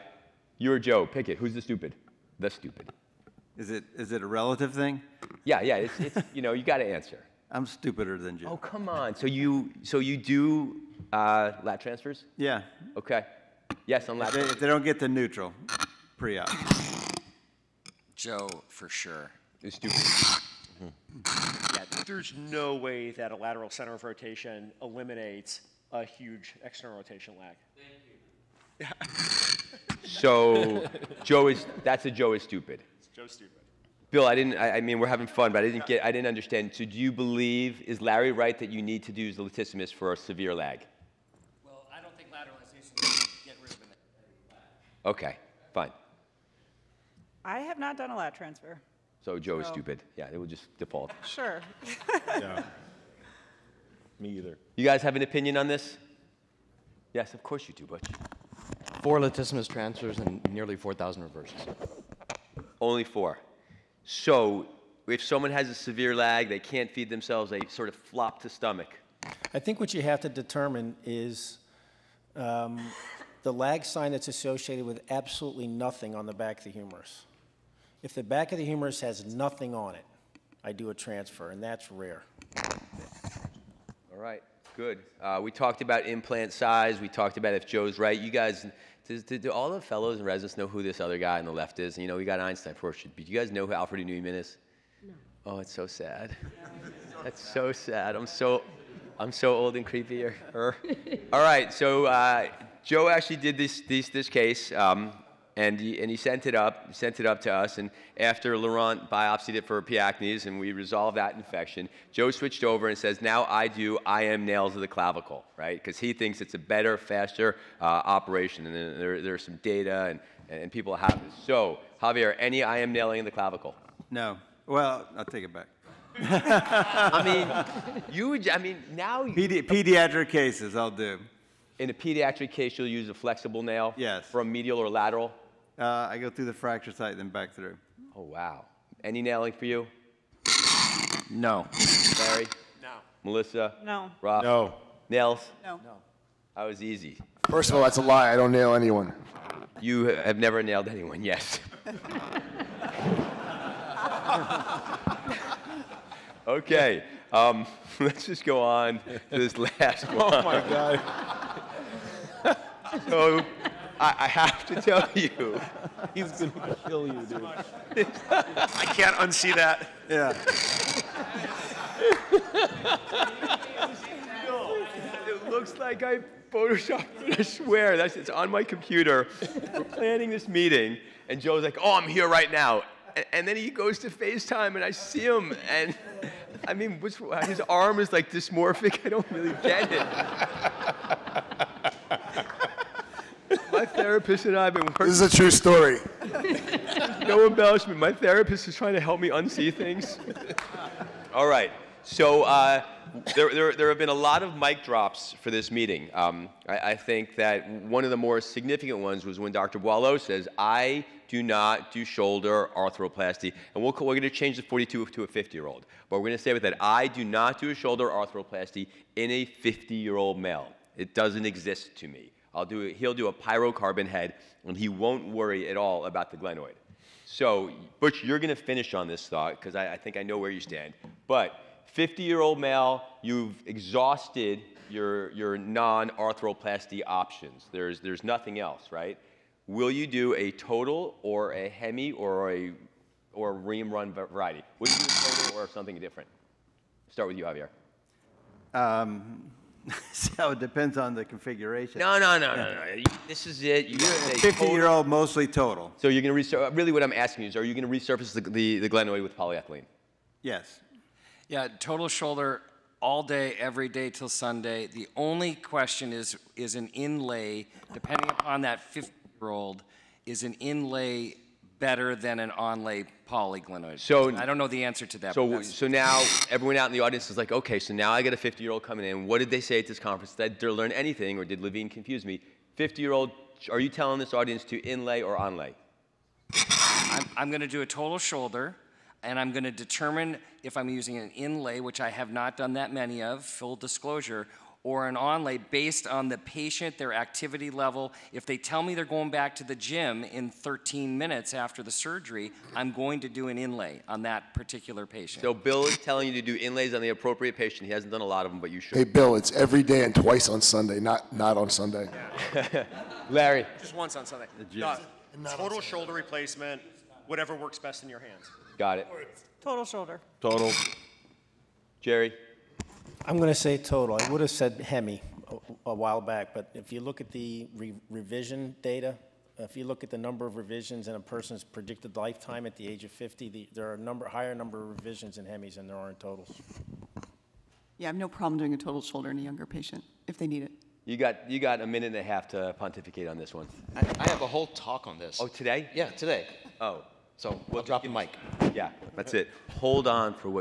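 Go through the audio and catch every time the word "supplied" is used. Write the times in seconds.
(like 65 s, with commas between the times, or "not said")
not said.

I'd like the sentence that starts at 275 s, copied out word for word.
So so now everyone out in the audience is like, okay, so now I got a 50 year old coming in.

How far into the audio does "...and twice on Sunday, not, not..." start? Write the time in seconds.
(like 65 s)
310 s.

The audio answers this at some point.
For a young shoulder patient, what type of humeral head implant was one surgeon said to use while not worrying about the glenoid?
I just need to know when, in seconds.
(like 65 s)
223 s.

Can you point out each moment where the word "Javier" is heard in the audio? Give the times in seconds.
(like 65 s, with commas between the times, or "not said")
122 s, 247 s.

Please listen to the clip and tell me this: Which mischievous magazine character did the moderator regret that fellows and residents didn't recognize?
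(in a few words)
Alfred Neuman.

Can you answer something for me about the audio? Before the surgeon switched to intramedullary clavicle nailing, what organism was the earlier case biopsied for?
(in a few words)
P. acnes.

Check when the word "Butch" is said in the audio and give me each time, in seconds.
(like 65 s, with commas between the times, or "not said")
57 s, 227 s.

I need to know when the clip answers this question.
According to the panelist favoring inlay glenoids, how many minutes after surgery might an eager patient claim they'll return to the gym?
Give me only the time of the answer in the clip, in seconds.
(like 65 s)
300 s.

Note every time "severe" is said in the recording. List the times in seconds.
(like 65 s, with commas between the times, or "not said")
40 s, 65 s.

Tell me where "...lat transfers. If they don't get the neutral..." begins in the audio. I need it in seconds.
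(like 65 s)
14 s.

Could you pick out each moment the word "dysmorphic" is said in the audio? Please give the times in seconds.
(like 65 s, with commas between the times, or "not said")
188 s.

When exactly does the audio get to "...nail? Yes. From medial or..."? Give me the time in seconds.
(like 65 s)
133 s.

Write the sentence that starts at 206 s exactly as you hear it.
Um, I, I, think that one of the more significant ones was when Dr.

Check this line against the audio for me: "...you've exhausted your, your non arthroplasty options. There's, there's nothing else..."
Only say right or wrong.
right.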